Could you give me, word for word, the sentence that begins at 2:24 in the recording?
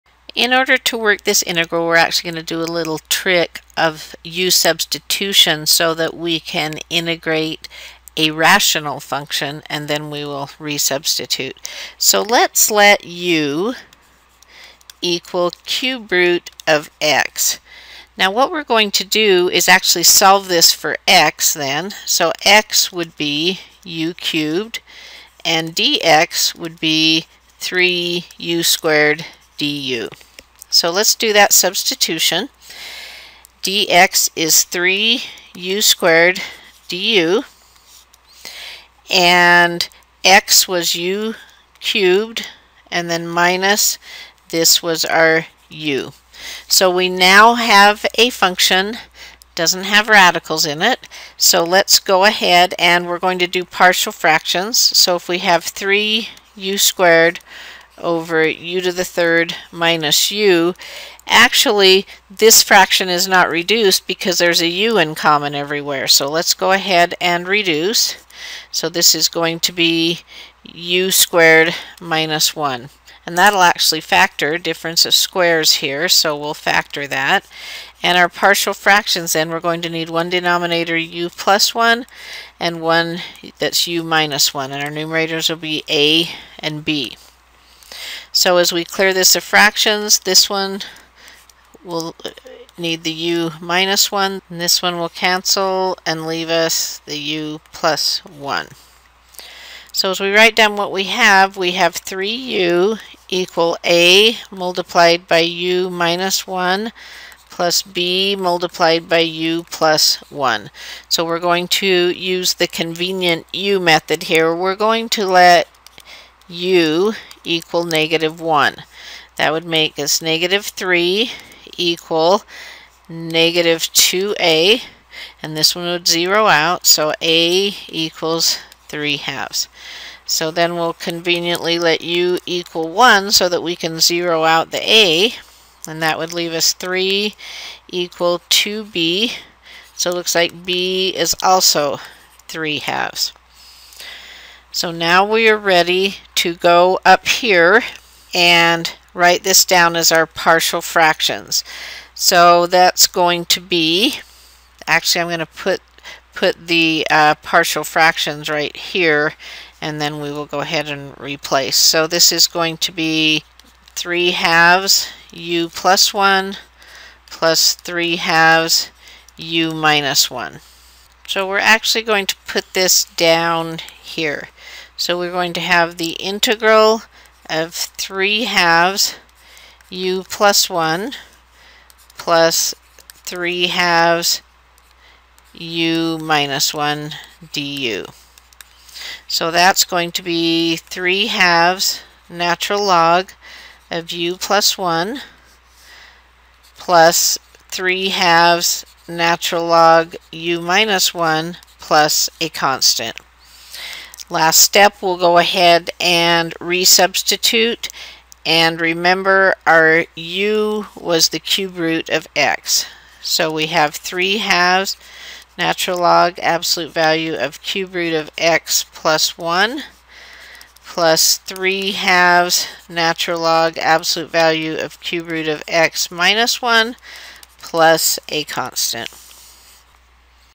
So now we are ready to go up here and write this down as our partial fractions.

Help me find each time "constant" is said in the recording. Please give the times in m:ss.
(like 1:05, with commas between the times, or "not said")
3:22, 3:48.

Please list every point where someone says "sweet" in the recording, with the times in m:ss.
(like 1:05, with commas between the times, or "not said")
not said.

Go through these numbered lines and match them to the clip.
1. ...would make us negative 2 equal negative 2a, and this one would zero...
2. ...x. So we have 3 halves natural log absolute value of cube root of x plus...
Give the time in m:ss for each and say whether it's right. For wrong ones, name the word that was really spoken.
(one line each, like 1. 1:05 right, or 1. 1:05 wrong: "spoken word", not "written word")
1. 1:59 wrong: "3", not "2"
2. 3:32 right.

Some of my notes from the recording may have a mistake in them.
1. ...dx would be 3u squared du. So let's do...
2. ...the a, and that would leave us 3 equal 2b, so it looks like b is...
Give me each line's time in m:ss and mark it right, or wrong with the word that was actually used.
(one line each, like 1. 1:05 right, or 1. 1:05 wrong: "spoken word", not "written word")
1. 0:25 right
2. 2:14 right.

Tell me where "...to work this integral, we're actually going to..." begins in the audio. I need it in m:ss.
0:00.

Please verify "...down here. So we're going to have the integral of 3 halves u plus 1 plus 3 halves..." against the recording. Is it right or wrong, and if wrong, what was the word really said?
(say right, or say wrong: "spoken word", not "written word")
right.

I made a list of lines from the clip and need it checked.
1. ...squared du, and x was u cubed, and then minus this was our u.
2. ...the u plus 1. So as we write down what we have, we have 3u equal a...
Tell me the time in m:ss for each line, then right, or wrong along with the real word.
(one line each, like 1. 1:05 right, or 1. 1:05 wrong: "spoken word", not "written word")
1. 0:35 right
2. 1:37 right.